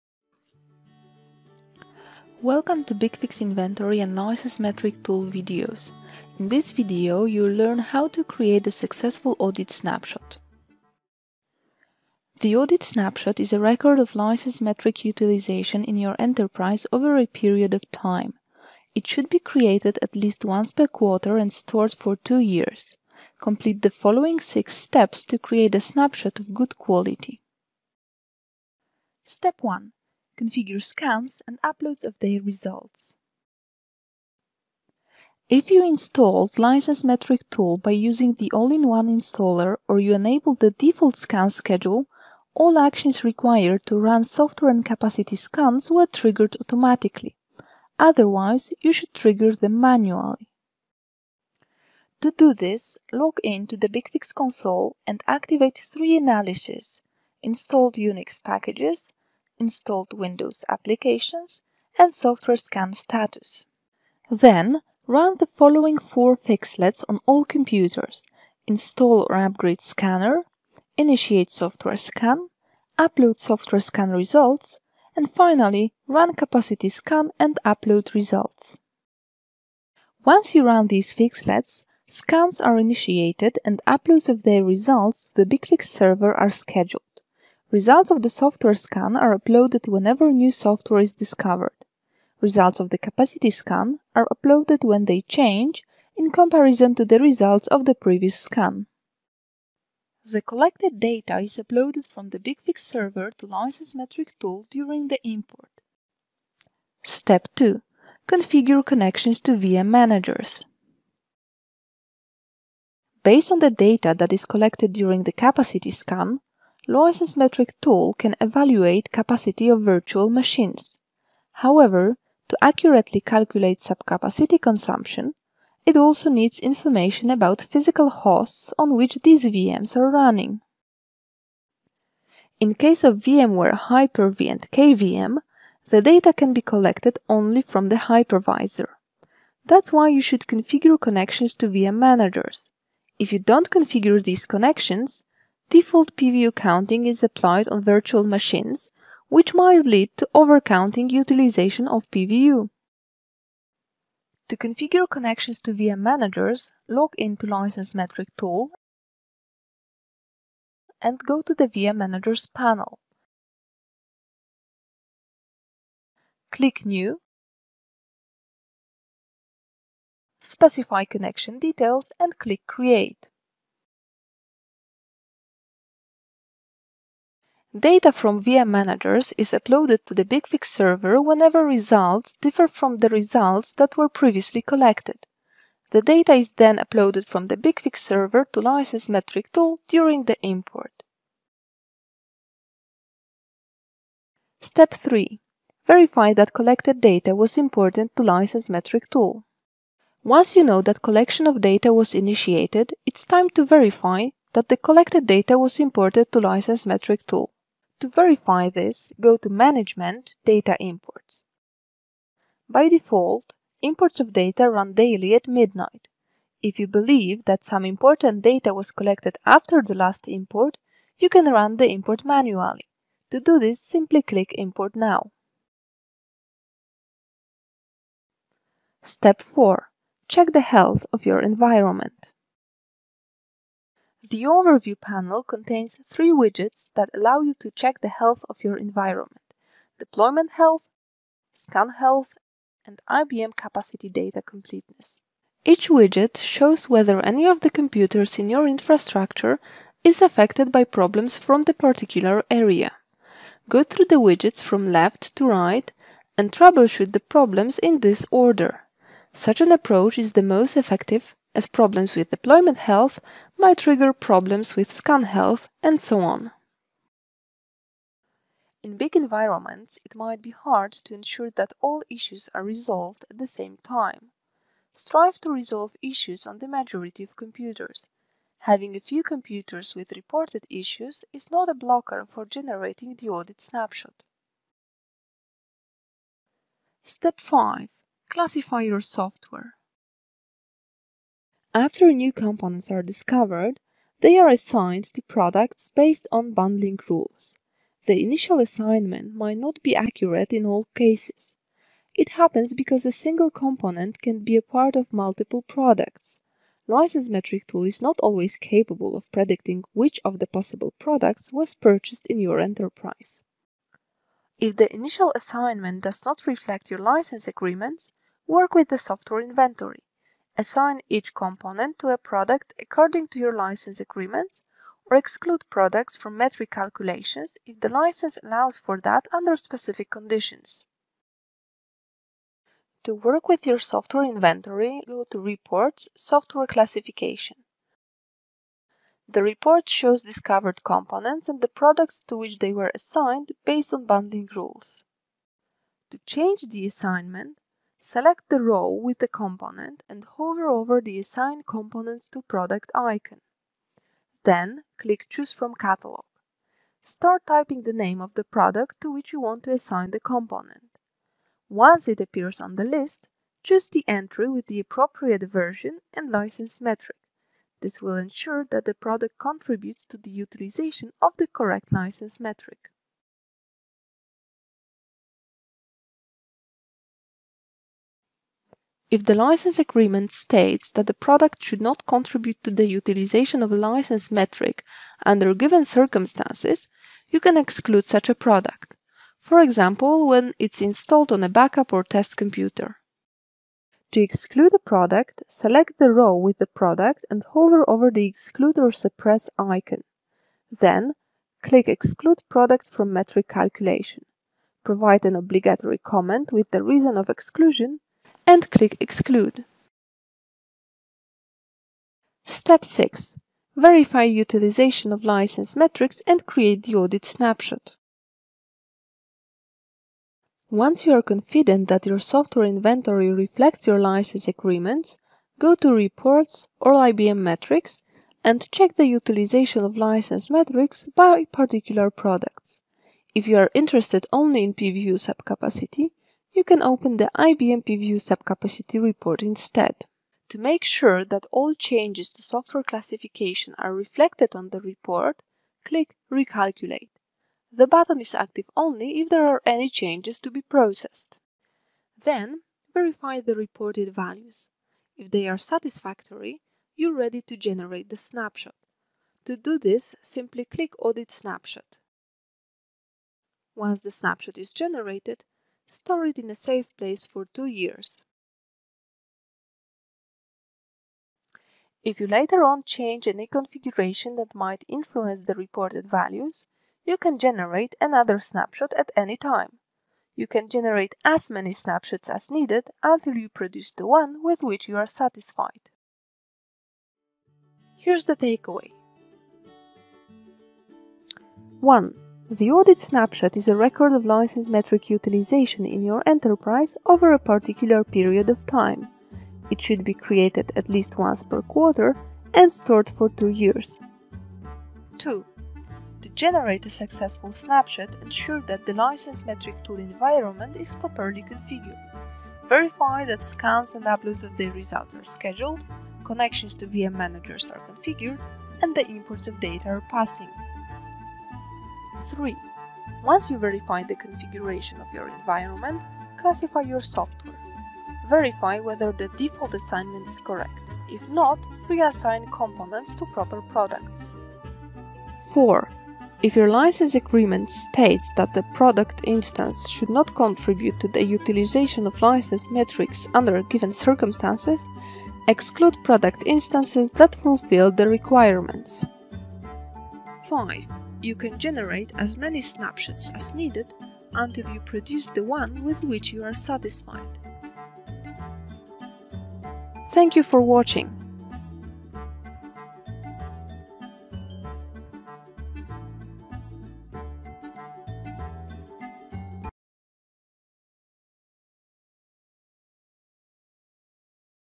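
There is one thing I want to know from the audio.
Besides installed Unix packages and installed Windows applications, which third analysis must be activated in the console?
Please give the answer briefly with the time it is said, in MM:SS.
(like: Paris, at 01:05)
Software scan status, at 01:02.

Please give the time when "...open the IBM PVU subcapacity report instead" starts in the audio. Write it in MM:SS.
07:16.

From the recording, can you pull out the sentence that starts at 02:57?
Data from VM managers is uploaded to the BigFix server whenever results differ from the results that were previously collected.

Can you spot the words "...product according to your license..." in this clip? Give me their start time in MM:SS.
05:22.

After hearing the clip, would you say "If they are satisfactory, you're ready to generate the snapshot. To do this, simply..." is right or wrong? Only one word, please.
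right.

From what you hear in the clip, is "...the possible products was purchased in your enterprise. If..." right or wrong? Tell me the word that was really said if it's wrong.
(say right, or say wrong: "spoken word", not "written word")
right.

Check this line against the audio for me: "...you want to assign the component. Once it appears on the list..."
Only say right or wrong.
right.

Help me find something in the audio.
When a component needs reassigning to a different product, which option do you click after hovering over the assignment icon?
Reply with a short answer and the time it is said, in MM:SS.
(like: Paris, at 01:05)
Choose from catalog, at 05:55.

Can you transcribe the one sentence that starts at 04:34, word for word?
Strive to resolve issues on the majority of computers.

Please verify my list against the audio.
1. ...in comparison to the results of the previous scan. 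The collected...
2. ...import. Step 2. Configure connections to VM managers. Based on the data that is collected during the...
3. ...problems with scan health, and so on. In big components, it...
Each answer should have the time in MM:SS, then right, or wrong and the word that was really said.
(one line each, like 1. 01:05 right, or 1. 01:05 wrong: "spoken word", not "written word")
1. 01:36 right
2. 01:45 right
3. 04:24 wrong: "environments", not "components".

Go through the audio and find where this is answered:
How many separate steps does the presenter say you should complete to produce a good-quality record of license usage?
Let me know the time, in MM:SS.
00:24.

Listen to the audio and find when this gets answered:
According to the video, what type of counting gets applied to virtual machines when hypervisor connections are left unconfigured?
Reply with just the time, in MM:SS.
02:25.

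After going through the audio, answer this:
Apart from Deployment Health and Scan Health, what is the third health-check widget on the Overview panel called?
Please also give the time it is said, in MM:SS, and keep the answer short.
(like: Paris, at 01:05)
IBM Capacity Data Completeness, at 04:03.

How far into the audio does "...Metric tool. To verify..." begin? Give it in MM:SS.
03:26.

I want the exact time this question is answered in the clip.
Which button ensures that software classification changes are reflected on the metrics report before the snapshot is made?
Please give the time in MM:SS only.
07:26.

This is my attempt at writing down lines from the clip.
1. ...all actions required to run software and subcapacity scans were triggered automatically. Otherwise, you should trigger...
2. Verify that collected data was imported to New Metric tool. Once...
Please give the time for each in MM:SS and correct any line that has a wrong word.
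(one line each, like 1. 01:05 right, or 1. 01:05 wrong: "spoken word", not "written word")
1. 00:42 wrong: "capacity", not "subcapacity"
2. 03:15 wrong: "License", not "New".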